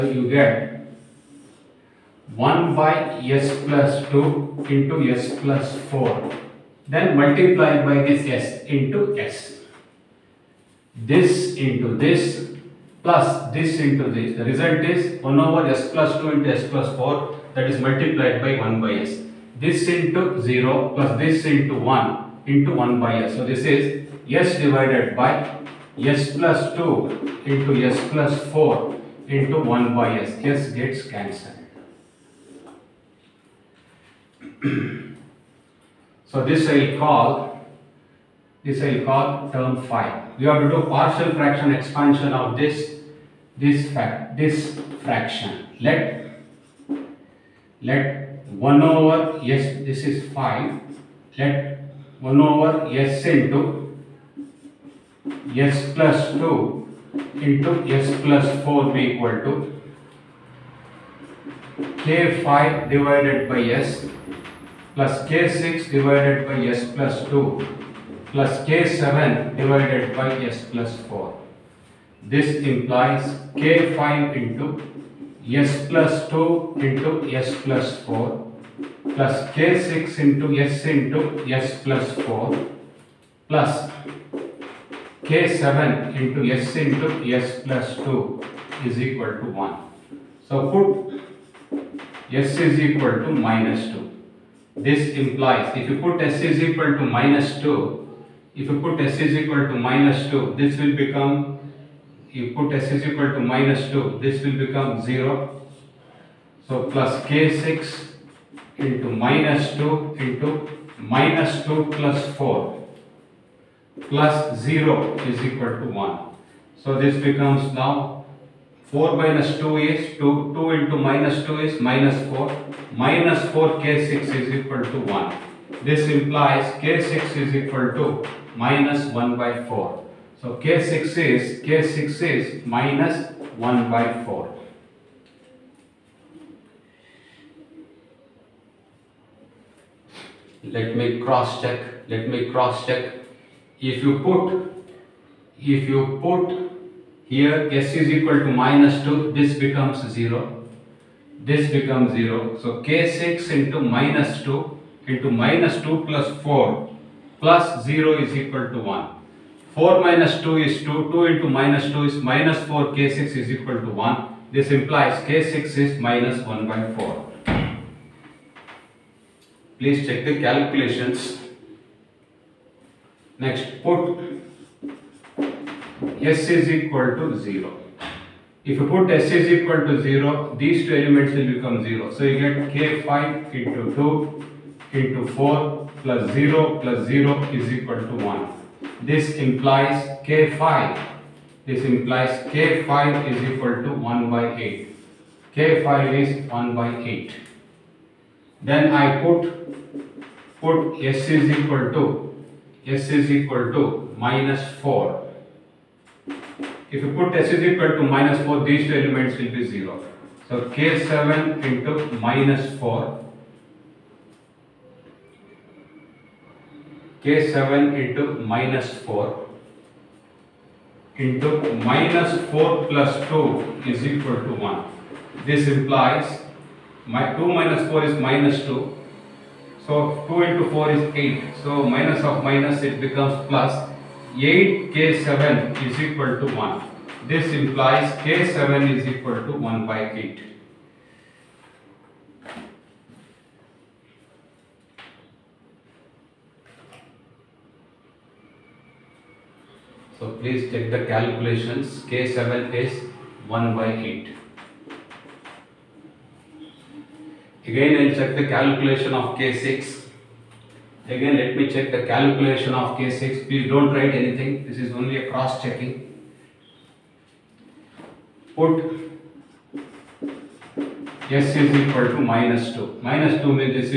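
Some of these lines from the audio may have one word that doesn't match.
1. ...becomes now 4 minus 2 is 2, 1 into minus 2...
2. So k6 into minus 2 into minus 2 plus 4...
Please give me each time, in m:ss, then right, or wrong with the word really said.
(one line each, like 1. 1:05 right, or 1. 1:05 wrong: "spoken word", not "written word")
1. 1:57 wrong: "2", not "1"
2. 2:32 right.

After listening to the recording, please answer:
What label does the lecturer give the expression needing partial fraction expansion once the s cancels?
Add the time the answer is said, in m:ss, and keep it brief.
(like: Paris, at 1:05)
term 5, at 0:39.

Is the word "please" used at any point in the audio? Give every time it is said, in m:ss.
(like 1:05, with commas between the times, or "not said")
2:49, 4:10, 4:23.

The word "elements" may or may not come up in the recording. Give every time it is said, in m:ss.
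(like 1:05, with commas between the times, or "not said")
3:00, 3:29.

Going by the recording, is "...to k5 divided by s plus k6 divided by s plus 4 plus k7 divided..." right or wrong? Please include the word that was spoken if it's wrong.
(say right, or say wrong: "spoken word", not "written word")
wrong: "2", not "4".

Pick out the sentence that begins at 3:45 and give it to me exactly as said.
This implies my 2 minus 4 is minus 2.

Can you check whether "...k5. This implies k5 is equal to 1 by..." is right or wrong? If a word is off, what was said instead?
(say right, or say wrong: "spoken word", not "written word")
right.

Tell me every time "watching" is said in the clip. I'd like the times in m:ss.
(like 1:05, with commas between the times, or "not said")
not said.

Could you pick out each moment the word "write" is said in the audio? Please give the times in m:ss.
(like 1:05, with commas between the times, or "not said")
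4:23.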